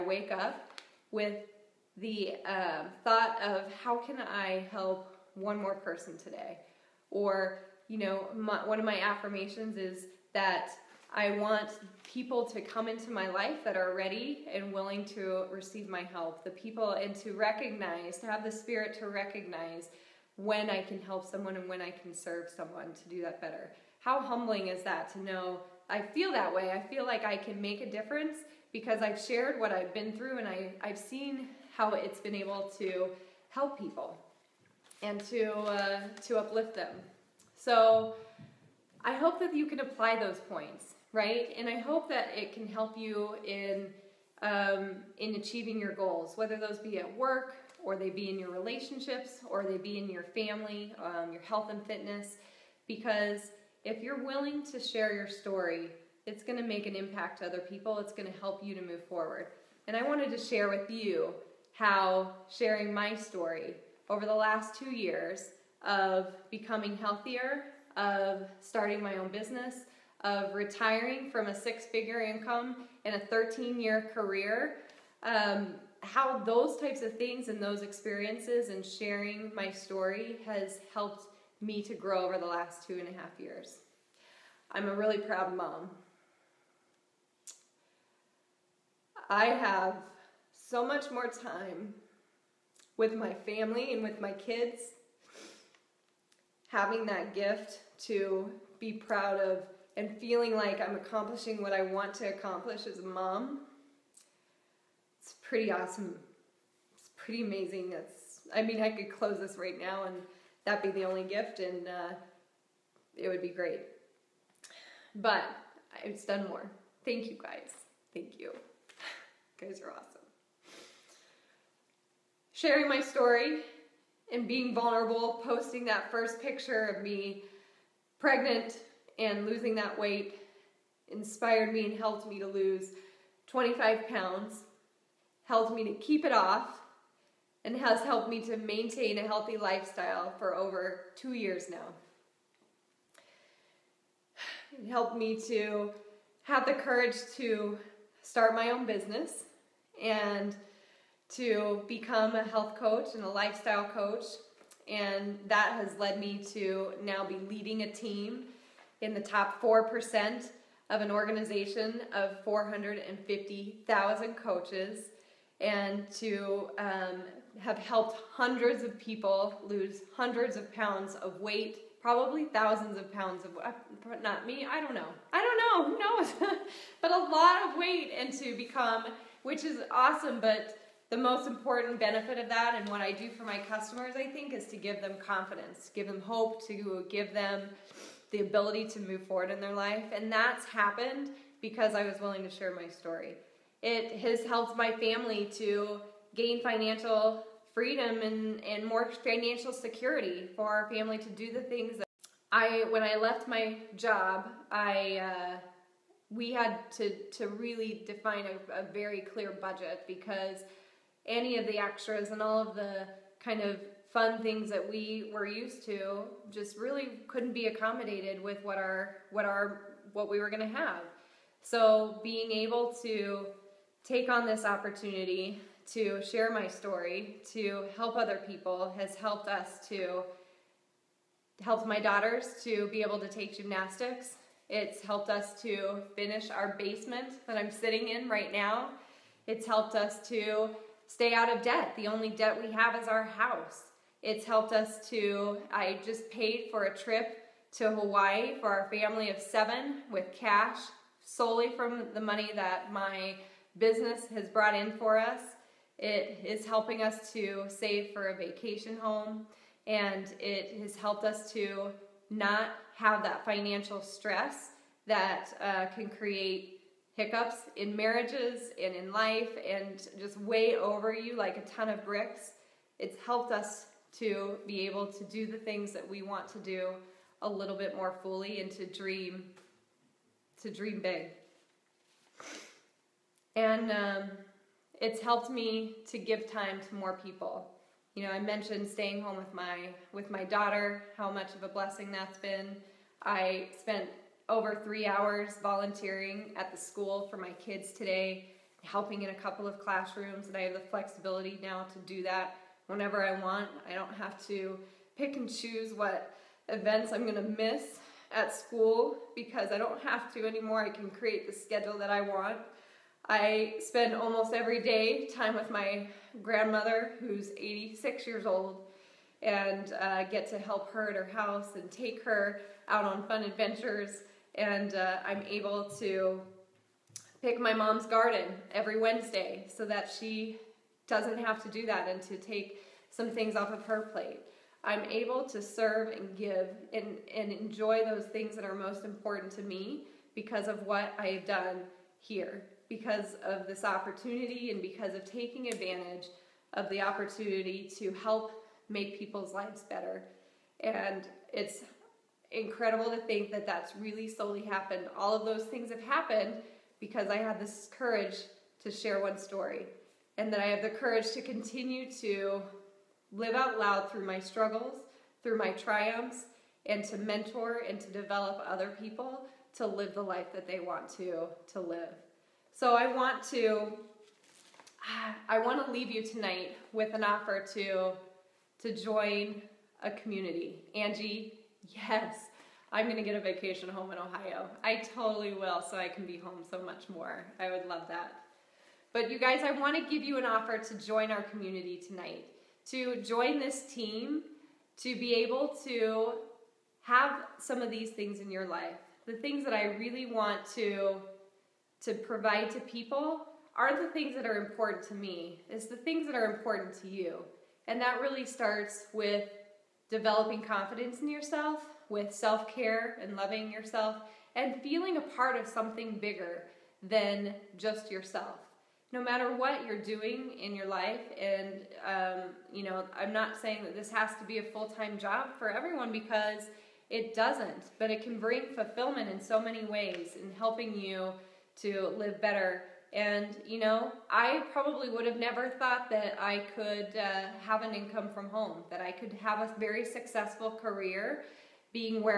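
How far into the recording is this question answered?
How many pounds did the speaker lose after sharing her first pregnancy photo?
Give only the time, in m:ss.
2:13.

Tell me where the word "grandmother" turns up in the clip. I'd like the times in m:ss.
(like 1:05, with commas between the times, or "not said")
5:16.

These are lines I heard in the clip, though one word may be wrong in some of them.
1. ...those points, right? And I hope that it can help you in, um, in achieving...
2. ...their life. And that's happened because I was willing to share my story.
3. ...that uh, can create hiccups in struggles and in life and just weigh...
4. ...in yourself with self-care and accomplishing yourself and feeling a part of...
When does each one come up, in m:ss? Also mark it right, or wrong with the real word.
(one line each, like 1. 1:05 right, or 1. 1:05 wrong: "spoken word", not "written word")
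1. 0:40 right
2. 3:09 right
3. 4:25 wrong: "marriages", not "struggles"
4. 6:51 wrong: "loving", not "accomplishing".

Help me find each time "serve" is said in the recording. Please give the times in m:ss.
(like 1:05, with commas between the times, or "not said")
0:22, 5:35.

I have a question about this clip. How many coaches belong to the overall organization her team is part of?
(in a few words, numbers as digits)
450,000.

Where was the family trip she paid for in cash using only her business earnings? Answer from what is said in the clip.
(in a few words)
Hawaii.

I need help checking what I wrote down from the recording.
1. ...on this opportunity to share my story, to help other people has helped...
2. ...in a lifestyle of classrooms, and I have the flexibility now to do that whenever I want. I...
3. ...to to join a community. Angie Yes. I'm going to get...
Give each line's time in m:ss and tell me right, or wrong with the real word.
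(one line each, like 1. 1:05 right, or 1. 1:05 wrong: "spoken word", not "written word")
1. 3:44 right
2. 4:59 wrong: "couple", not "lifestyle"
3. 6:17 right.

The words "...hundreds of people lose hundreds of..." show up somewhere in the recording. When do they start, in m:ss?
2:48.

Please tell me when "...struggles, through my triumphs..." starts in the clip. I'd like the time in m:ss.
6:04.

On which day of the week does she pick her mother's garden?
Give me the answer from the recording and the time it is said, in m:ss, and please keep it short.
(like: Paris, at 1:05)
Wednesday, at 5:28.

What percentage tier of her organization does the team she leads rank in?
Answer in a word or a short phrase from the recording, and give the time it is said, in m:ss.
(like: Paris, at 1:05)
top 4%, at 2:39.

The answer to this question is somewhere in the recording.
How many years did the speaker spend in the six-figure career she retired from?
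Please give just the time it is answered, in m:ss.
1:13.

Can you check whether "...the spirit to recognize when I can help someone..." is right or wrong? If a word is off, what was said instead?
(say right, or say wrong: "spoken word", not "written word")
right.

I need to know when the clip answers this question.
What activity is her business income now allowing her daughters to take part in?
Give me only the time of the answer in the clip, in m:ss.
3:53.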